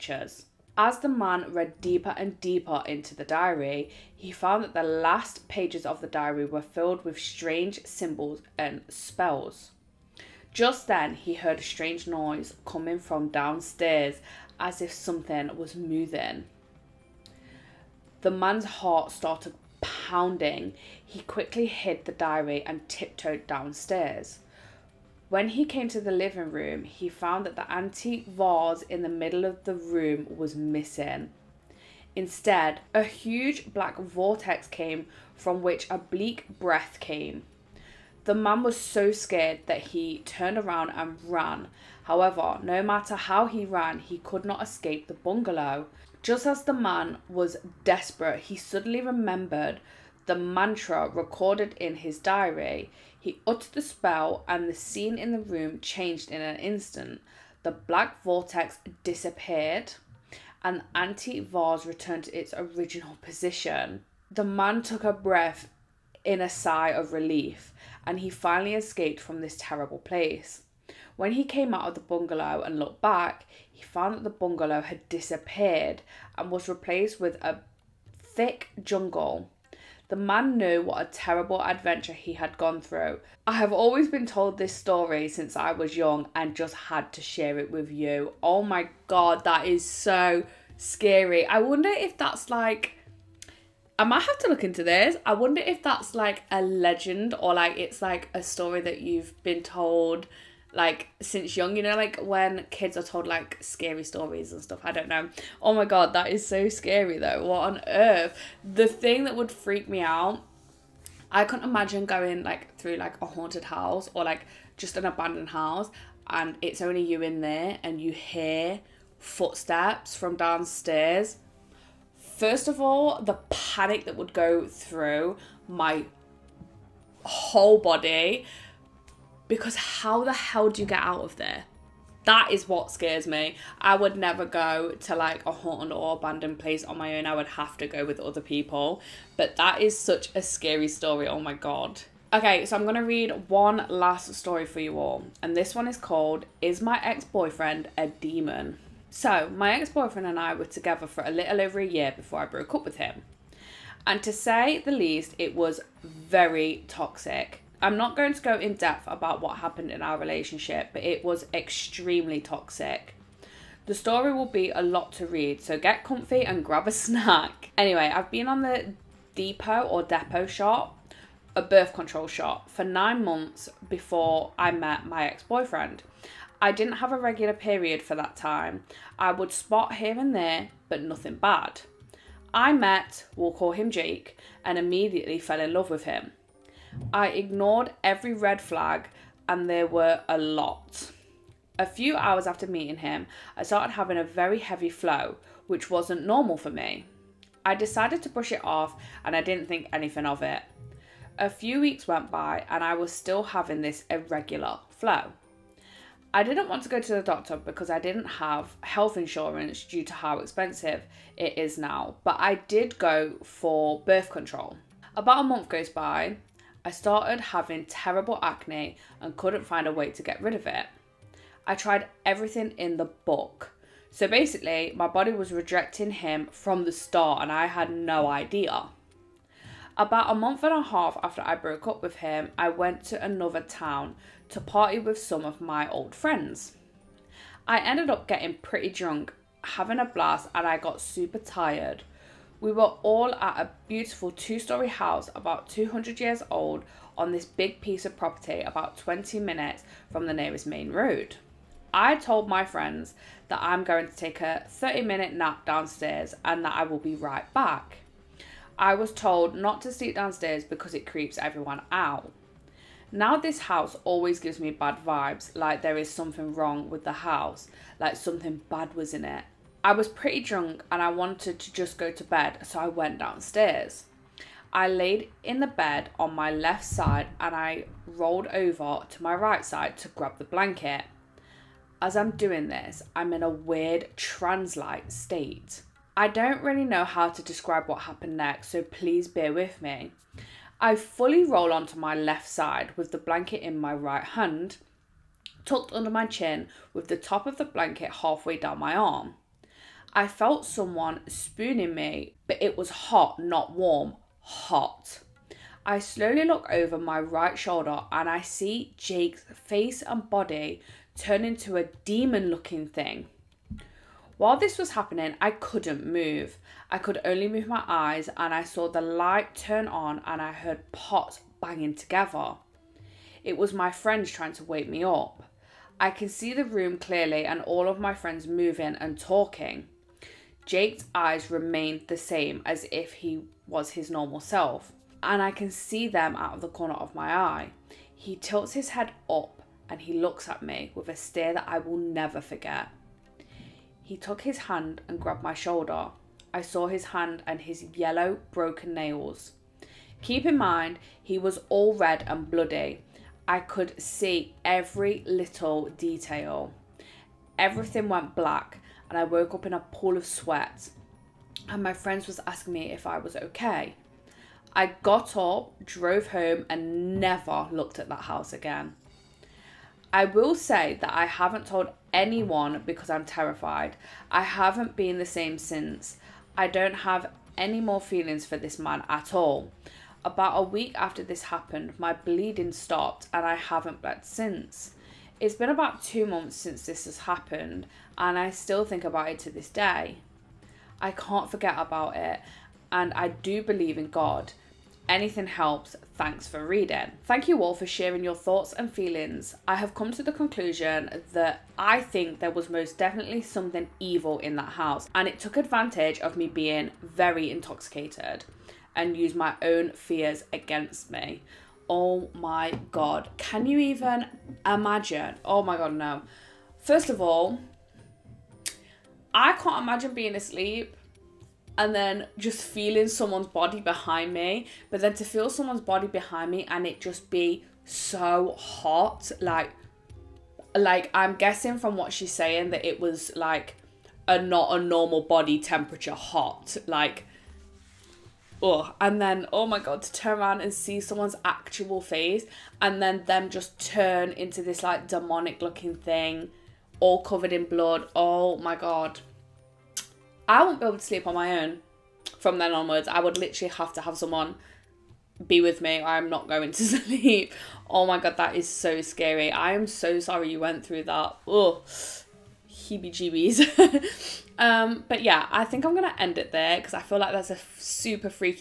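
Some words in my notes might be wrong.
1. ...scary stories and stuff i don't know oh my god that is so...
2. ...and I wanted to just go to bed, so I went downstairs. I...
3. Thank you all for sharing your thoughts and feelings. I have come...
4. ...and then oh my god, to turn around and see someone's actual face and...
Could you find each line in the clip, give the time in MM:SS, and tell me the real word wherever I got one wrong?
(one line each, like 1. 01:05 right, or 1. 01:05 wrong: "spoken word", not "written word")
1. 01:43 right
2. 04:30 right
3. 06:37 right
4. 07:18 right.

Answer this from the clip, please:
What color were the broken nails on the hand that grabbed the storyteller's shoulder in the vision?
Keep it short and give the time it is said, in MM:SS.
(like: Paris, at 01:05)
Yellow, at 05:47.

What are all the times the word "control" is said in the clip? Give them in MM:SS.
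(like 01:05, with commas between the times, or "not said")
02:51, 03:34.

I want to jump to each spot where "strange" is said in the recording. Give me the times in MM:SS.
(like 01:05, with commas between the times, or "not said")
00:07, 00:11.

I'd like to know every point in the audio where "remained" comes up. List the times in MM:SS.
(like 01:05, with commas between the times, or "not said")
05:31.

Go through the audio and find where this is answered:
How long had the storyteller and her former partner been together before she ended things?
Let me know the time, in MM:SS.
02:31.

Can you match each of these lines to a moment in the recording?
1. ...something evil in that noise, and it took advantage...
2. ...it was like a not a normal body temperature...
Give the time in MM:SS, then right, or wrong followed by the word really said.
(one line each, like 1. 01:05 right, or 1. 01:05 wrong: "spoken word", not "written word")
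1. 06:43 wrong: "house", not "noise"
2. 07:12 right.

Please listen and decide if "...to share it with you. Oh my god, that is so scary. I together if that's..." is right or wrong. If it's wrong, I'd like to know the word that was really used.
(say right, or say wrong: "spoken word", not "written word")
wrong: "wonder", not "together".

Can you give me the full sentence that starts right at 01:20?
The man knew what a terrible adventure he had gone through.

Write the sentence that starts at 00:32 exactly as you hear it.
Instead, a huge black vortex came from which a bleak breath came.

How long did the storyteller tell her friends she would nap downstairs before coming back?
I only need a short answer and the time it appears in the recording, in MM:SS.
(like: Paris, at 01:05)
30 minutes, at 04:14.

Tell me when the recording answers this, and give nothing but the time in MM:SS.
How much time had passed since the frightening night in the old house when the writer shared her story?
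06:26.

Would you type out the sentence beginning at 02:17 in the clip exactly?
I would have to go with other people.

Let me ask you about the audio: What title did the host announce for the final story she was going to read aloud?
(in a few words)
Is My Ex Boyfriend a Demon?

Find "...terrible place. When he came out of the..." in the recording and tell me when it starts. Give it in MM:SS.
01:09.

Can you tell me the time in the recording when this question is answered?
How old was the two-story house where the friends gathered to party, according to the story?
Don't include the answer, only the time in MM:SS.
04:05.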